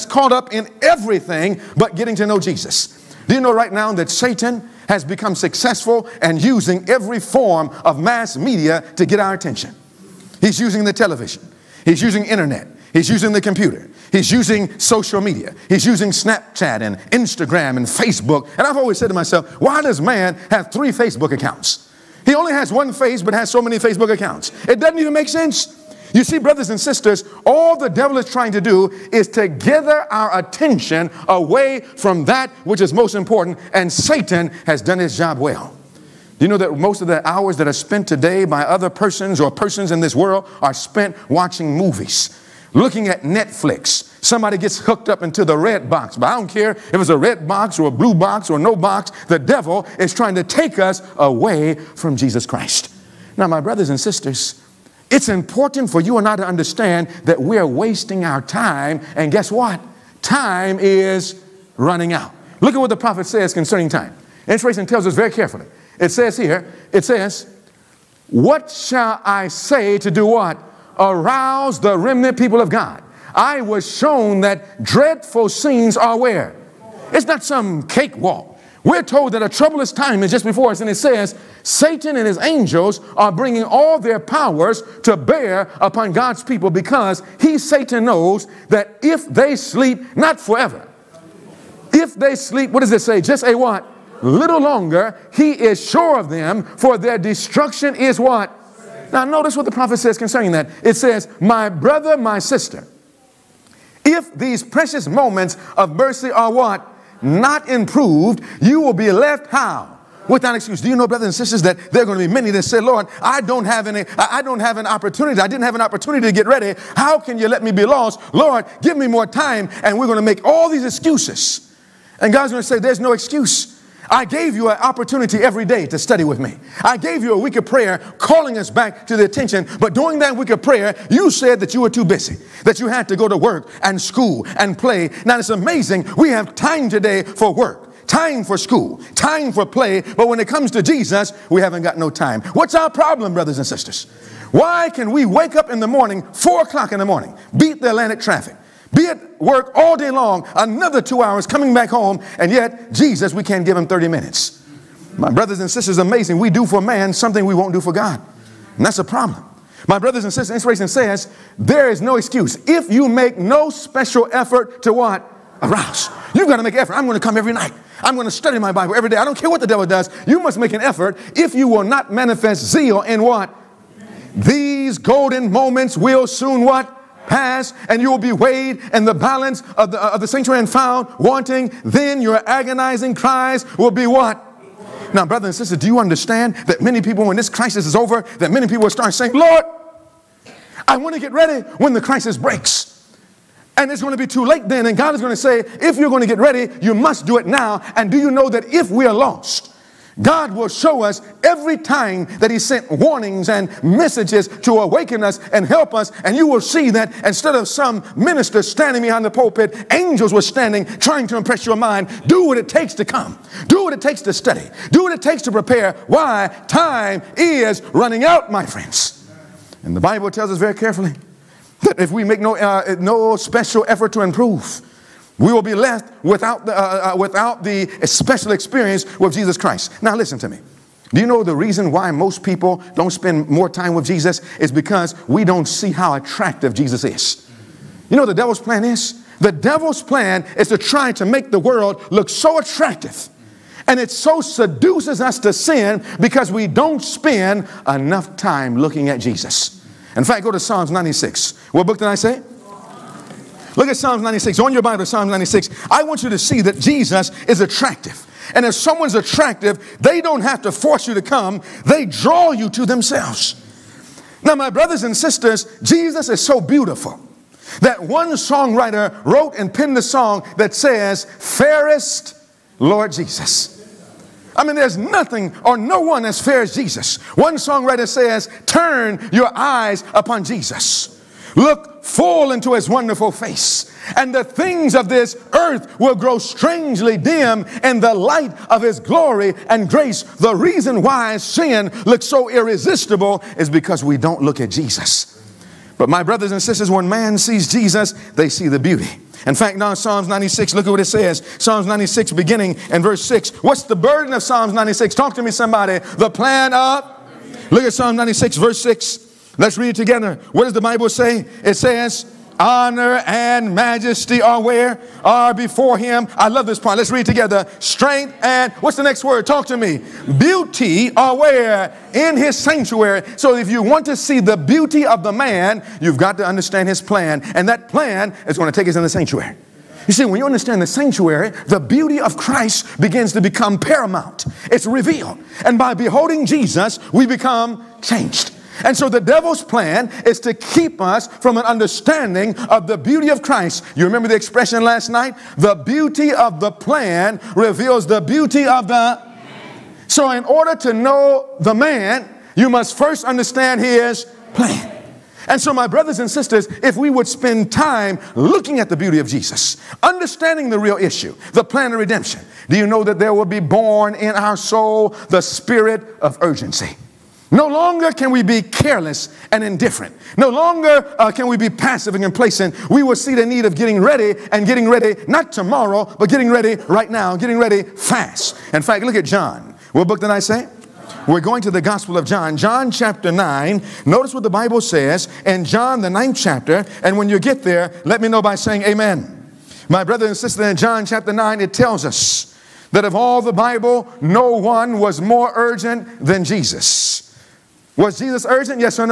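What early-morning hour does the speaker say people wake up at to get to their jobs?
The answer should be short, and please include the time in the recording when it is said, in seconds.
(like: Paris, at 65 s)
4 o'clock, at 146 s.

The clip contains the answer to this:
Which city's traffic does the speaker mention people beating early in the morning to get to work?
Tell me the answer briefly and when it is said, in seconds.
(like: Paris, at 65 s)
Atlanta, at 147 s.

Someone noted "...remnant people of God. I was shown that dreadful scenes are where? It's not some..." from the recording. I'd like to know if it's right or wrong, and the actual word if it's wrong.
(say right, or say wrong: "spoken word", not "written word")
right.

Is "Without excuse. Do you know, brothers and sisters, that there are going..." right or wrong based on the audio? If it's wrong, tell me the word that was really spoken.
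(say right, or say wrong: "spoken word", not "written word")
right.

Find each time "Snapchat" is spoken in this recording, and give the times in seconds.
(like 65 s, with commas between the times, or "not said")
16 s.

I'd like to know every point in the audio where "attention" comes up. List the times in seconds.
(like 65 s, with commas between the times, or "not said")
9 s, 30 s, 129 s.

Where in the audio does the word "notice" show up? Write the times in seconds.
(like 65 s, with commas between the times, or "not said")
99 s, 384 s.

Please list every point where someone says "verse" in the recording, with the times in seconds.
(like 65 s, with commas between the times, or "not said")
303 s, 308 s.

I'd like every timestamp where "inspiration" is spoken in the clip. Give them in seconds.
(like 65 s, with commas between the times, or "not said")
64 s, 160 s.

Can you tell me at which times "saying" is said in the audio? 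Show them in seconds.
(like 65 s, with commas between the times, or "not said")
189 s, 388 s.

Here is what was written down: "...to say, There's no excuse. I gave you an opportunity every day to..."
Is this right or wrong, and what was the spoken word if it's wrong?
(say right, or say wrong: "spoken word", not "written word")
right.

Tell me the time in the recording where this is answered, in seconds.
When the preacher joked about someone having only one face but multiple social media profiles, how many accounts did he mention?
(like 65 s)
20 s.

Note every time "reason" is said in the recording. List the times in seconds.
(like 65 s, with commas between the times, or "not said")
231 s, 290 s.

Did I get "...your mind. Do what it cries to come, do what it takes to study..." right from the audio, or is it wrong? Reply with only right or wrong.
wrong.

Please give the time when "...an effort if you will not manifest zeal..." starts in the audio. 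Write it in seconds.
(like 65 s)
170 s.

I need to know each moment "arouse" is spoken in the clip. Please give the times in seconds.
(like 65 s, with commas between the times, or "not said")
70 s, 165 s.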